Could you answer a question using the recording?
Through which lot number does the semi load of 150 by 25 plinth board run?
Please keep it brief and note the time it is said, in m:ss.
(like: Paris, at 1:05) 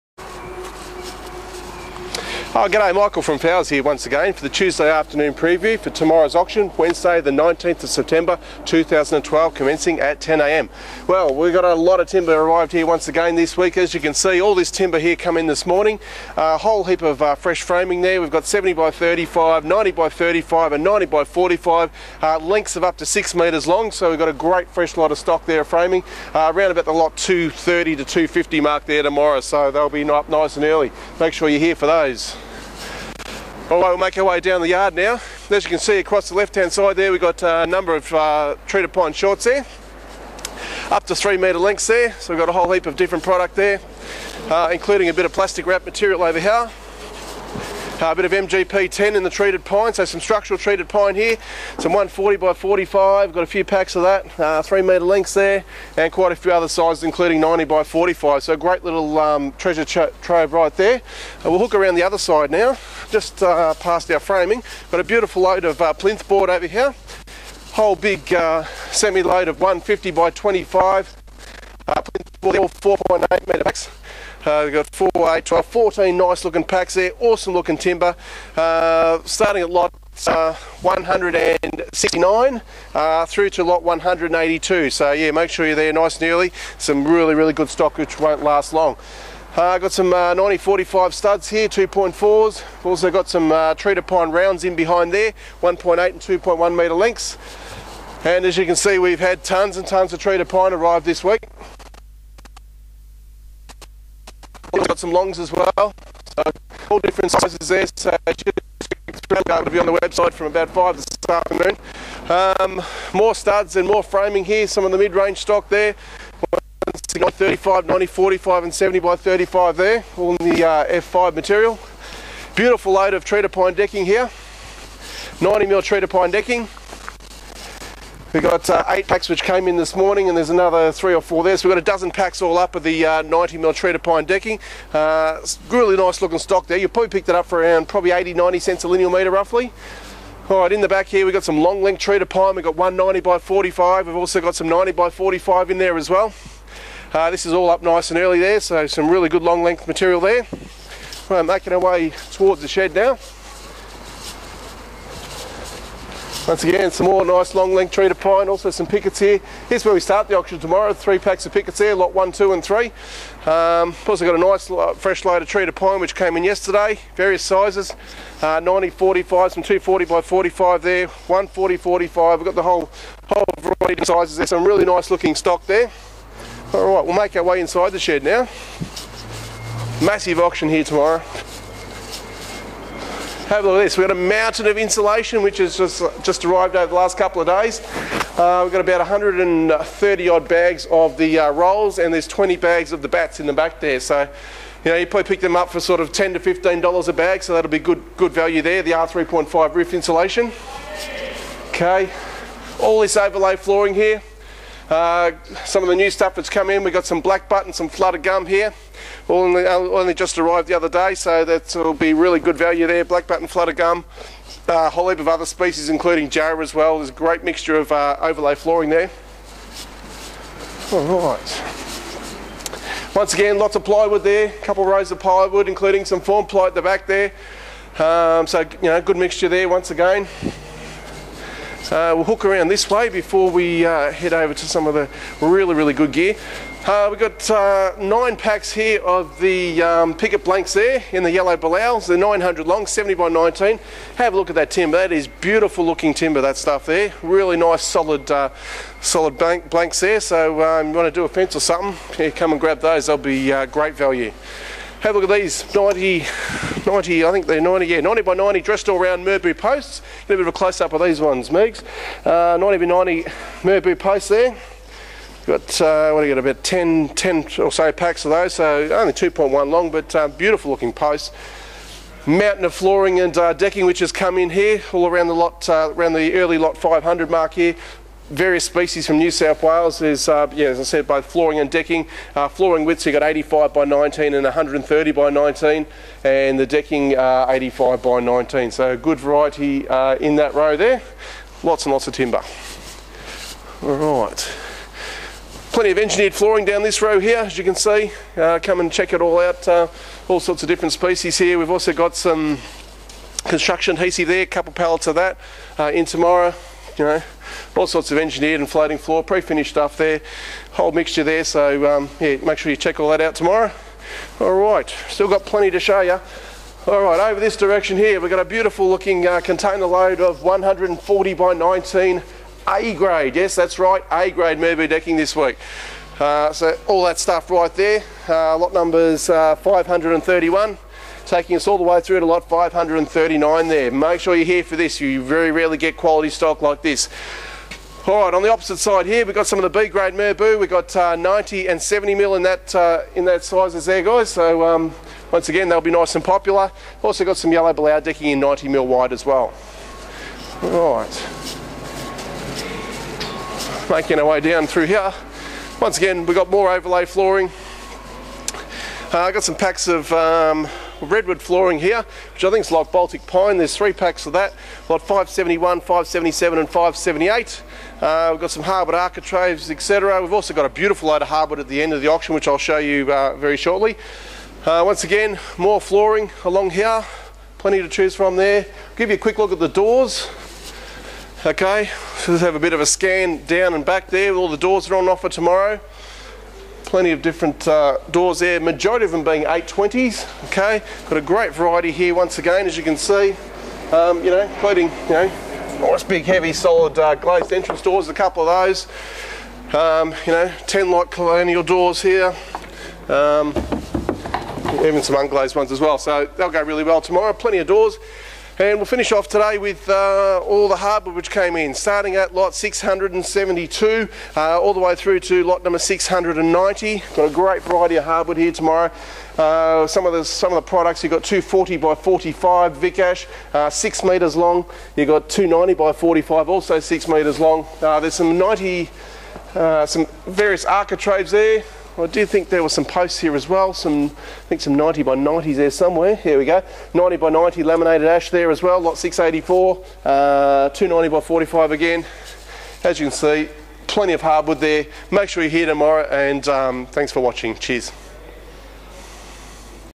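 182, at 1:23.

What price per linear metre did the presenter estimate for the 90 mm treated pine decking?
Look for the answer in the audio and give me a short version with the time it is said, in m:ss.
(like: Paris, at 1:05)
80 to 90 cents, at 2:18.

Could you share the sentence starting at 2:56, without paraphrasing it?
Alright, we'll make our way inside the shed now.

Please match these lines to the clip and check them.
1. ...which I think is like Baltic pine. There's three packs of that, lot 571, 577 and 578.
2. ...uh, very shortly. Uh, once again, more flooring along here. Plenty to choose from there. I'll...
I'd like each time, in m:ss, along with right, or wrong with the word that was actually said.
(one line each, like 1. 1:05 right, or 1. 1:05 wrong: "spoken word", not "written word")
1. 6:02 right
2. 6:13 right.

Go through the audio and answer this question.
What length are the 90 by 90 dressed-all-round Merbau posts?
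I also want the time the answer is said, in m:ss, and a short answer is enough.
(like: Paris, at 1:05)
2.1 metres, at 4:29.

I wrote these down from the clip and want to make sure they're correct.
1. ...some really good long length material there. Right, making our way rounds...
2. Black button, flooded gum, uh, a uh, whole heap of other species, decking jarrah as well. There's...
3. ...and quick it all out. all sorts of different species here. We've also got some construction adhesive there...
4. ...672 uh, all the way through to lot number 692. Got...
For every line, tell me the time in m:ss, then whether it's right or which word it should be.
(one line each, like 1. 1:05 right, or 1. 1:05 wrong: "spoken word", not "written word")
1. 2:28 wrong: "towards", not "rounds"
2. 3:33 wrong: "including", not "decking"
3. 4:58 wrong: "check", not "quick"
4. 6:52 wrong: "690", not "692".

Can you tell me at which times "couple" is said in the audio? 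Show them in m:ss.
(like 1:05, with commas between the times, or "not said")
3:07, 3:44, 5:04, 6:38.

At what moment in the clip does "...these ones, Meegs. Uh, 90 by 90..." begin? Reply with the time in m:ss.
4:21.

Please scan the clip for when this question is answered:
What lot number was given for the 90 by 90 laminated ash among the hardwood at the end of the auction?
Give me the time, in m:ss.
7:18.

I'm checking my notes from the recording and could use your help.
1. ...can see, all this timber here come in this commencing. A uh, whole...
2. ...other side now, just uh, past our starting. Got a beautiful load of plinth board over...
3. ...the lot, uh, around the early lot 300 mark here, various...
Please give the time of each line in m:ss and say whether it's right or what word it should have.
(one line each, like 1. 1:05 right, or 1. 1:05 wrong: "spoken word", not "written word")
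1. 0:14 wrong: "morning", not "commencing"
2. 1:02 wrong: "framing", not "starting"
3. 4:35 wrong: "500", not "300".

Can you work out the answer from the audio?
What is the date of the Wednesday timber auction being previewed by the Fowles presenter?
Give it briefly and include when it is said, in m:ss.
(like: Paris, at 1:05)
19 September 2012, at 0:06.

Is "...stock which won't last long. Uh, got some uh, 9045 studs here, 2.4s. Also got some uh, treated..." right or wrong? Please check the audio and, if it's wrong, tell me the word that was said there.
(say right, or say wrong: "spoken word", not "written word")
right.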